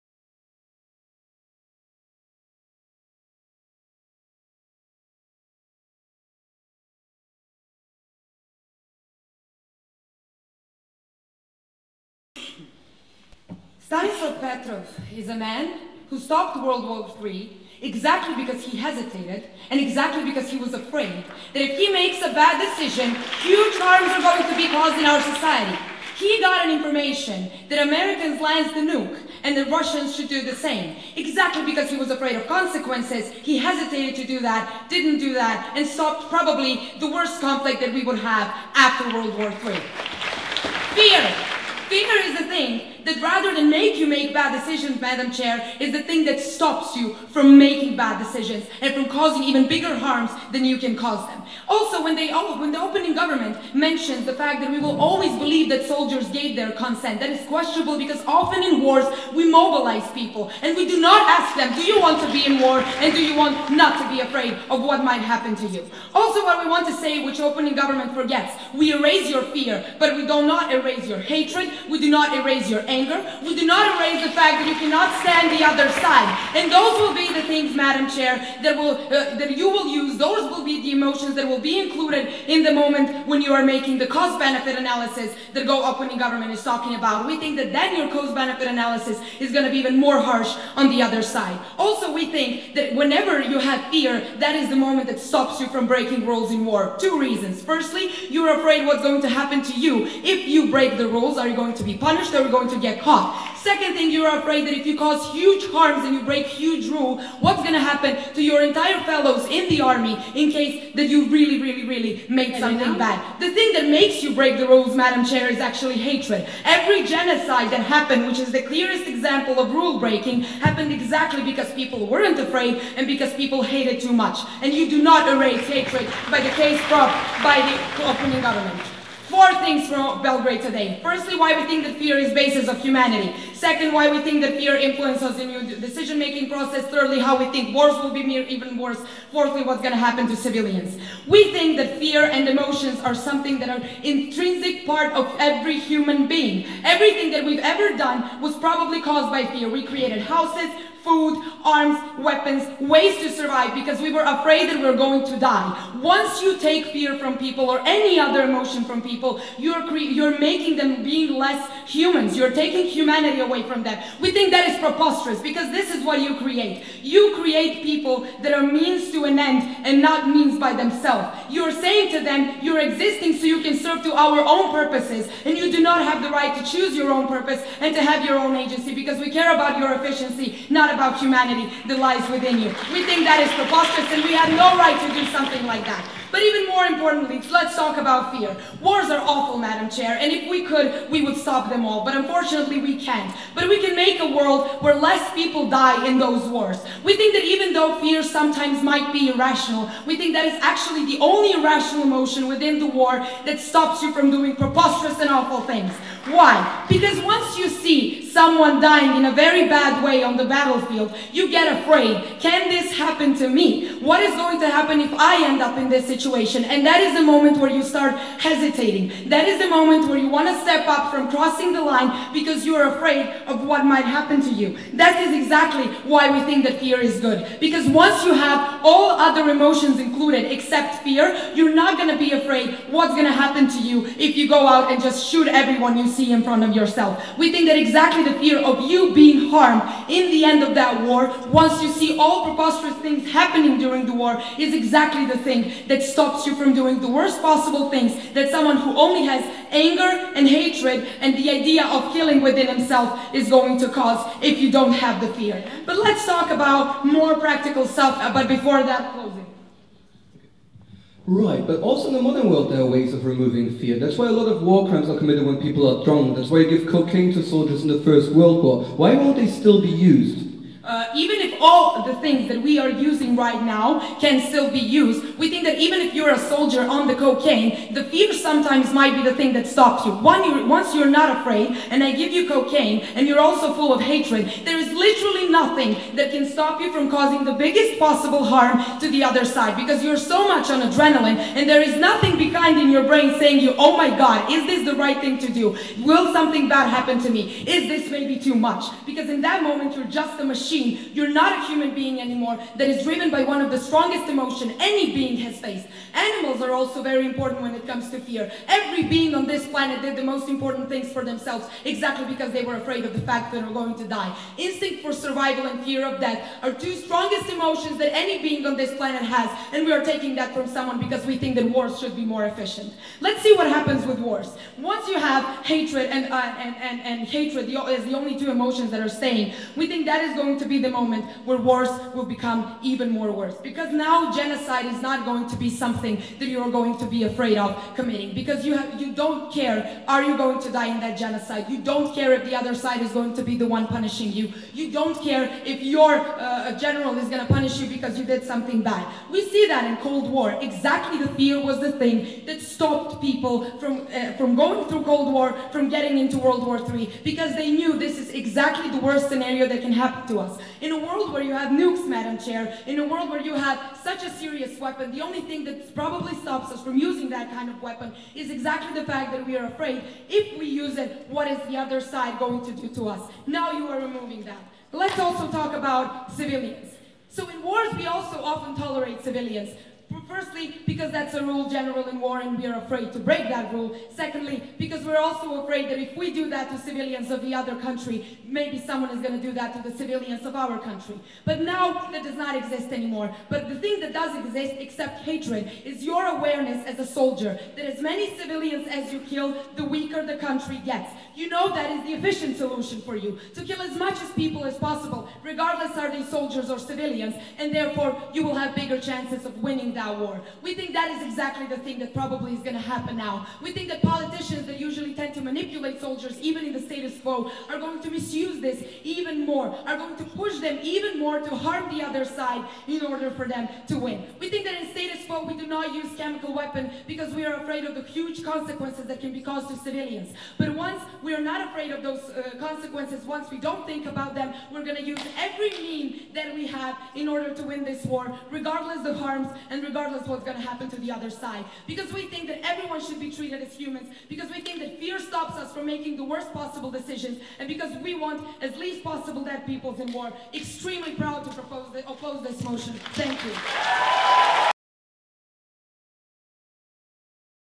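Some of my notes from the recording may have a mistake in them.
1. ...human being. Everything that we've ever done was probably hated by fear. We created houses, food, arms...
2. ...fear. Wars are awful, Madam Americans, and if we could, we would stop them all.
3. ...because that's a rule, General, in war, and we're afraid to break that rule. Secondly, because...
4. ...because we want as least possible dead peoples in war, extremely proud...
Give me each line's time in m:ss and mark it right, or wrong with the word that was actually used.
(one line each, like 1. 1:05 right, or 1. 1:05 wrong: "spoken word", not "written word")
1. 2:25 wrong: "caused", not "hated"
2. 3:08 wrong: "Chair", not "Americans"
3. 6:20 right
4. 7:27 right.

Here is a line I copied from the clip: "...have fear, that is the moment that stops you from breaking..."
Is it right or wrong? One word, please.
right.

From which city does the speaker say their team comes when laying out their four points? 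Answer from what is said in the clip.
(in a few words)
Belgrade.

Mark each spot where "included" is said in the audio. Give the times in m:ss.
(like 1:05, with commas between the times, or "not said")
1:21, 3:49.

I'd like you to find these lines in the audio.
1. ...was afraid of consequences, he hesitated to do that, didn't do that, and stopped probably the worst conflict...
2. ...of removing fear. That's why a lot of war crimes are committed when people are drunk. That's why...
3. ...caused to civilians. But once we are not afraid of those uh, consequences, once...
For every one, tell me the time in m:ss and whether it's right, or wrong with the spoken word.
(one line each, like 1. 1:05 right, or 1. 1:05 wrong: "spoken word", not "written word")
1. 0:31 right
2. 4:23 right
3. 7:09 right.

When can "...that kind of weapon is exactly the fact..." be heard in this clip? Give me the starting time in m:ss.
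6:07.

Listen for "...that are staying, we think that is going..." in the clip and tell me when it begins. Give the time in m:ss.
5:28.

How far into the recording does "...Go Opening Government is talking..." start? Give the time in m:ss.
1:25.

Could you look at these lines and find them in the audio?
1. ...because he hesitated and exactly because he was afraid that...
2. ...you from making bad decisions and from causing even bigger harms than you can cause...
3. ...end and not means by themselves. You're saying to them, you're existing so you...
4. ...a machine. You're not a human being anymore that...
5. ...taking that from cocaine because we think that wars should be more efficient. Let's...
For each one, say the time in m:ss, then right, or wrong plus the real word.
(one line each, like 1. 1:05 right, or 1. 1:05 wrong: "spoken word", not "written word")
1. 0:18 right
2. 0:46 right
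3. 2:49 right
4. 5:00 right
5. 5:20 wrong: "someone", not "cocaine".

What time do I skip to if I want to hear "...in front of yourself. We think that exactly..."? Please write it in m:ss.
3:56.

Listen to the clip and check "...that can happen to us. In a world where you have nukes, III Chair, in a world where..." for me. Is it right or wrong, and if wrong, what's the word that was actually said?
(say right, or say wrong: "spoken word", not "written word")
wrong: "Madam", not "III".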